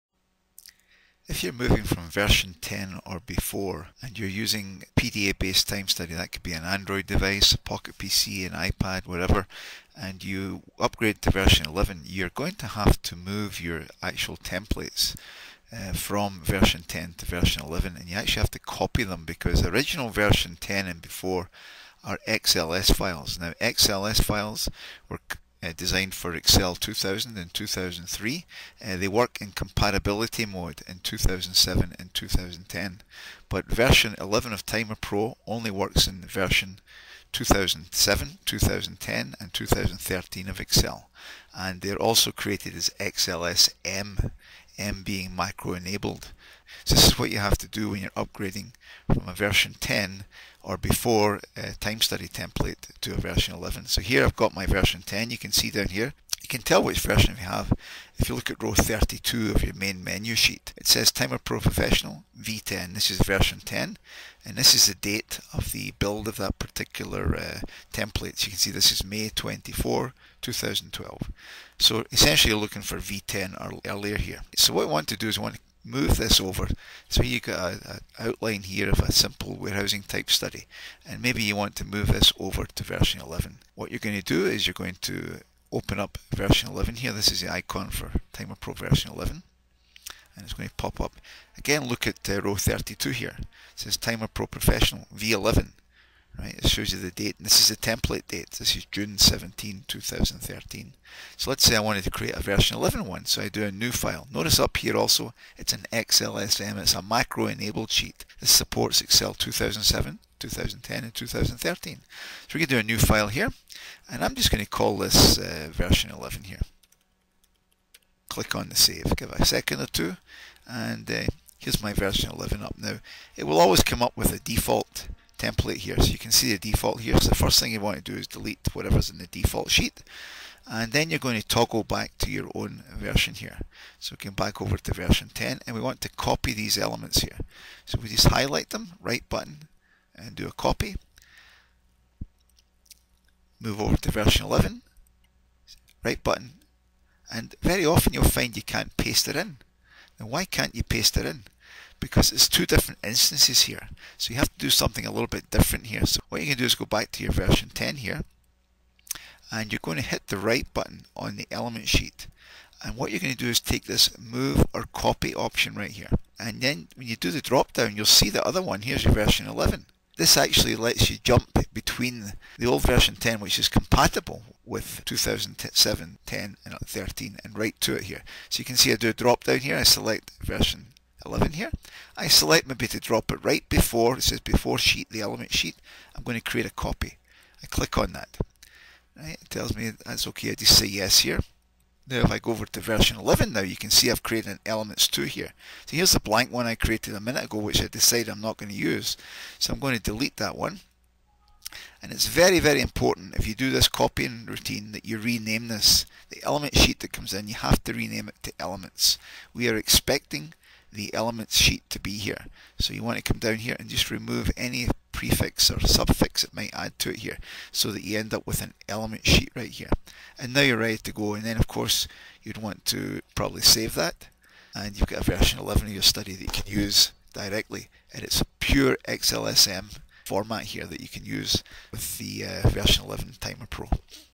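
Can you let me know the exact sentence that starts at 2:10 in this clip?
And then you're going to toggle back to your own version here.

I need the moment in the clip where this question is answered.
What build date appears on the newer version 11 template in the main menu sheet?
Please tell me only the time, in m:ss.
1:38.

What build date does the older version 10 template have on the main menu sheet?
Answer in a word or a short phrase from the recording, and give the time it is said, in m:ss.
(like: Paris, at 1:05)
May 24, 2012, at 1:09.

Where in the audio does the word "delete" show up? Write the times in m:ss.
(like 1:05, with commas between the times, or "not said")
2:08, 3:20.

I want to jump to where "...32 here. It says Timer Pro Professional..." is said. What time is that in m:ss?
1:32.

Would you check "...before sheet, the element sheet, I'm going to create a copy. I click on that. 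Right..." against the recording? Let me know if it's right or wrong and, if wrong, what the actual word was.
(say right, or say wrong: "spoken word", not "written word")
right.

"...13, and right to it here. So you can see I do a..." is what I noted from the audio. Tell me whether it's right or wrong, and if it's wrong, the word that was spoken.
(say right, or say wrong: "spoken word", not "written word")
right.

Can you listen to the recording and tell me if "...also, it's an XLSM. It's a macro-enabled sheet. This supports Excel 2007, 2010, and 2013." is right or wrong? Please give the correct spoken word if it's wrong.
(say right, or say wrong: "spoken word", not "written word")
right.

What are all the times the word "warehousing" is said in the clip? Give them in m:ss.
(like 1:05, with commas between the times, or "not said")
1:19.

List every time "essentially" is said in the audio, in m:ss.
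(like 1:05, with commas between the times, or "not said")
1:12.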